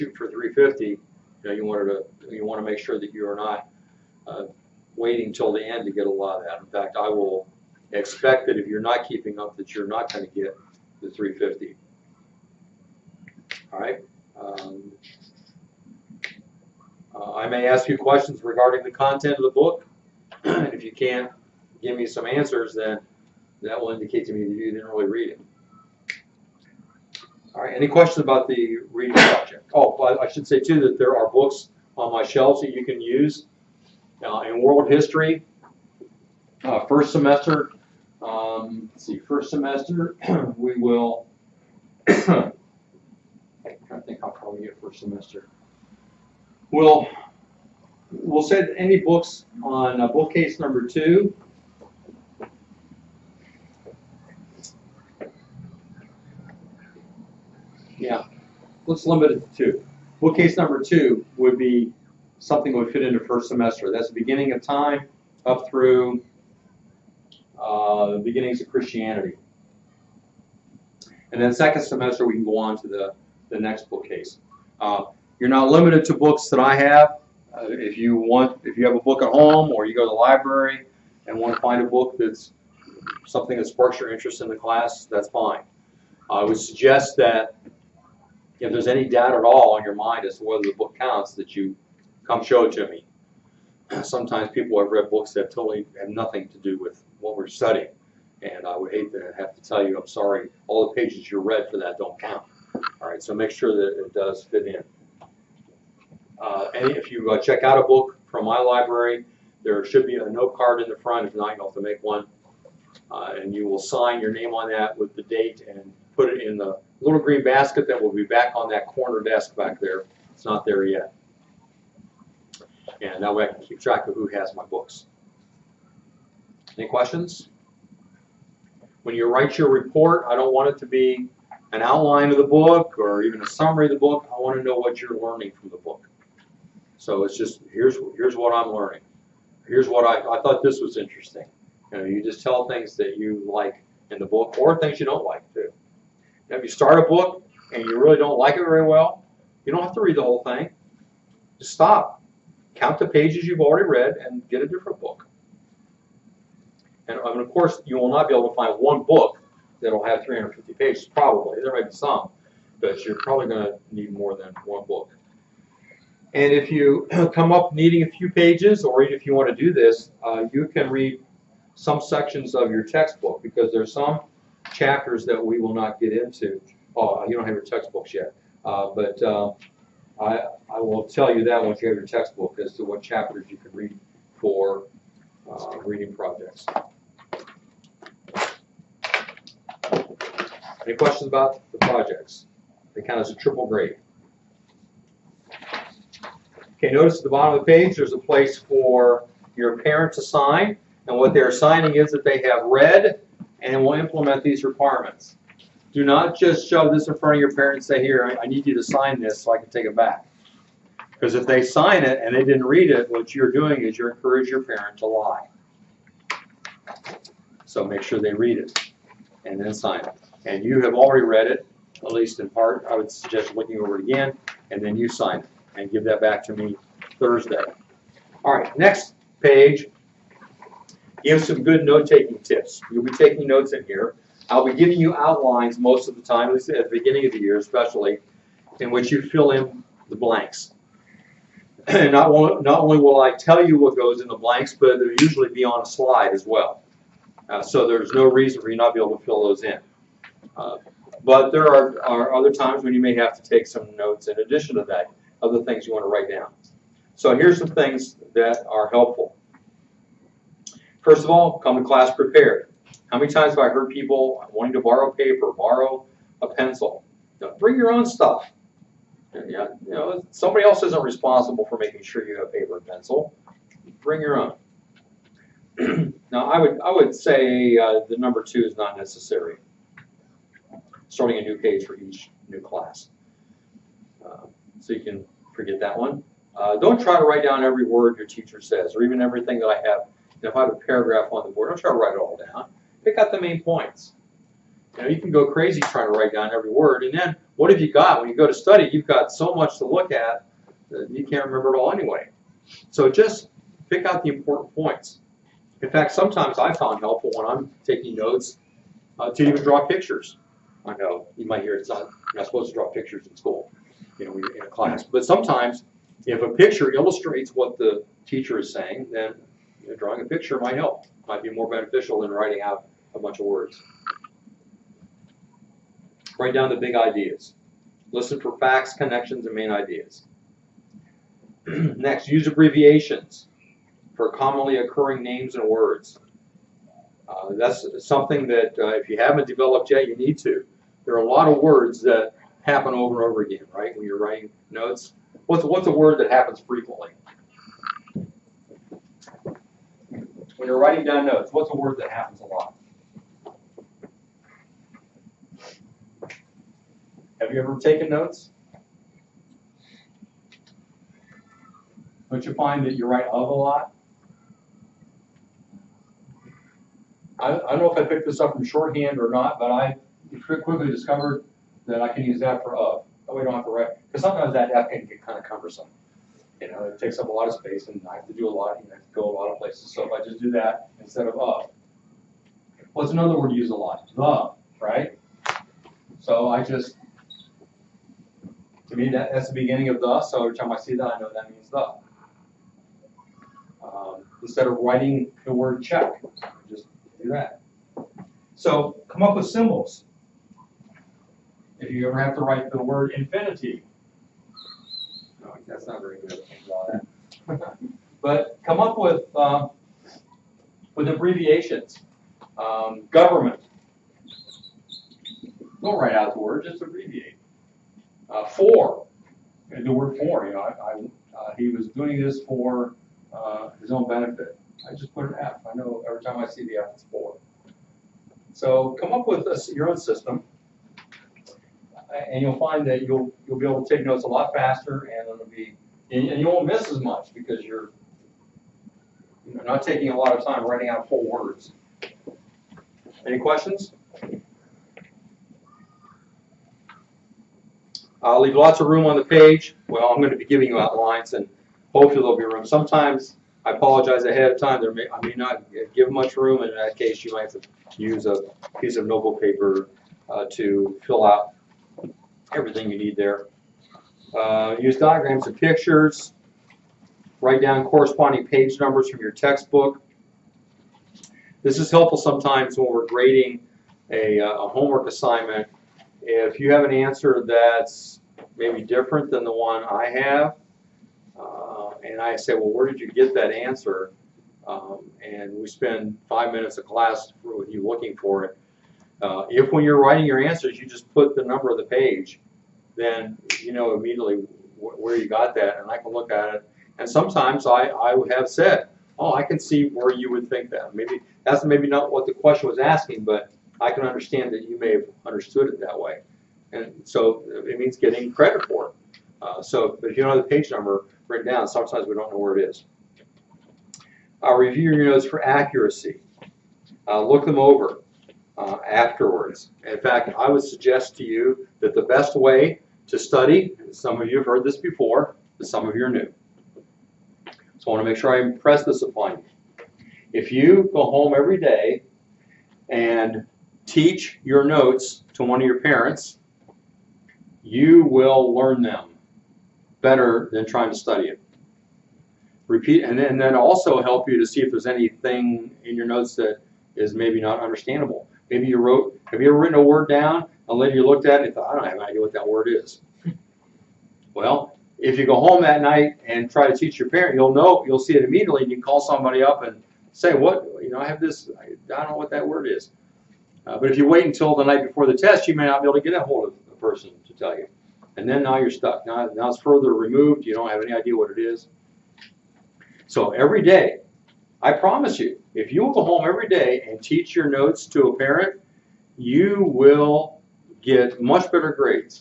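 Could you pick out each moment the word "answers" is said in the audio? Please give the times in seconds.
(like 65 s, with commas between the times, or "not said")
22 s, 476 s, 483 s, 490 s.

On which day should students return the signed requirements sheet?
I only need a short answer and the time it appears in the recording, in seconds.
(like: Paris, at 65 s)
Thursday, at 227 s.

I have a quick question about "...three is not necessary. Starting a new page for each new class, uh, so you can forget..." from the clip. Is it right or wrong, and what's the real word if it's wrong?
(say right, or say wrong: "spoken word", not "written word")
wrong: "two", not "three".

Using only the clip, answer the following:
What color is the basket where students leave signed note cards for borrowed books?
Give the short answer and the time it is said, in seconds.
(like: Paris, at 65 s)
Green, at 117 s.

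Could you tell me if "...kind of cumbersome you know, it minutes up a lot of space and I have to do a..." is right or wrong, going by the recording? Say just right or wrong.
wrong.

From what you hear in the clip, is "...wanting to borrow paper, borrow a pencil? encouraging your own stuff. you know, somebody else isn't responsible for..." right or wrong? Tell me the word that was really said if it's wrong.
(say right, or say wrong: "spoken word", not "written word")
wrong: "bring", not "encouraging".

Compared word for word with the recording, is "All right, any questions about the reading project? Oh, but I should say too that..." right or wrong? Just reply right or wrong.
right.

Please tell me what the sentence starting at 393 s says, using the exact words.
Um, instead of writing the word check, just do that.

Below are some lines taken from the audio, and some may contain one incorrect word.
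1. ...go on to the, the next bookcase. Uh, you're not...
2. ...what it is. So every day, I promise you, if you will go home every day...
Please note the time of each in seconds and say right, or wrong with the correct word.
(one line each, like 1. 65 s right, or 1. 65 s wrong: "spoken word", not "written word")
1. 72 s right
2. 571 s right.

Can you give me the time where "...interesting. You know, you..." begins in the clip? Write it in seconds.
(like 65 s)
140 s.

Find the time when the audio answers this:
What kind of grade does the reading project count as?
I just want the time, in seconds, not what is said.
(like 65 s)
193 s.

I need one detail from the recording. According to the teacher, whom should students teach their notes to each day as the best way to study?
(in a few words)
A parent.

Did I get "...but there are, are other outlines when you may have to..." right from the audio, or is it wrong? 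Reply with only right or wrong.
wrong.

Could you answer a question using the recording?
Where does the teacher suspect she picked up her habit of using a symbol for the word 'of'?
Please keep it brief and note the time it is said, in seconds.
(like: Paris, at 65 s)
Shorthand, at 368 s.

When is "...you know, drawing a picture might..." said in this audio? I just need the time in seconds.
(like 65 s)
319 s.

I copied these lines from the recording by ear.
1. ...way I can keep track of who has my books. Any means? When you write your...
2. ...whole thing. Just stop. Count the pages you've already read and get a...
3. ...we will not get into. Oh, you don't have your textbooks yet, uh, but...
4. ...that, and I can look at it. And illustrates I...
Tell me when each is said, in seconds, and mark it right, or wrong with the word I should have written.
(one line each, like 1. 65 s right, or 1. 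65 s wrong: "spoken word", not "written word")
1. 123 s wrong: "questions", not "means"
2. 150 s right
3. 175 s right
4. 495 s wrong: "sometimes", not "illustrates".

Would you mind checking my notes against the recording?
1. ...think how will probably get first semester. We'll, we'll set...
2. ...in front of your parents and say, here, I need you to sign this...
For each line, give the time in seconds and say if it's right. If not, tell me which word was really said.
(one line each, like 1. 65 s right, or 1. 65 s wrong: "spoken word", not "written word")
1. 44 s right
2. 207 s right.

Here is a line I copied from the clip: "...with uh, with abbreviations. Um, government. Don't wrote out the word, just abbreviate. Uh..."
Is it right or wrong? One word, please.
wrong.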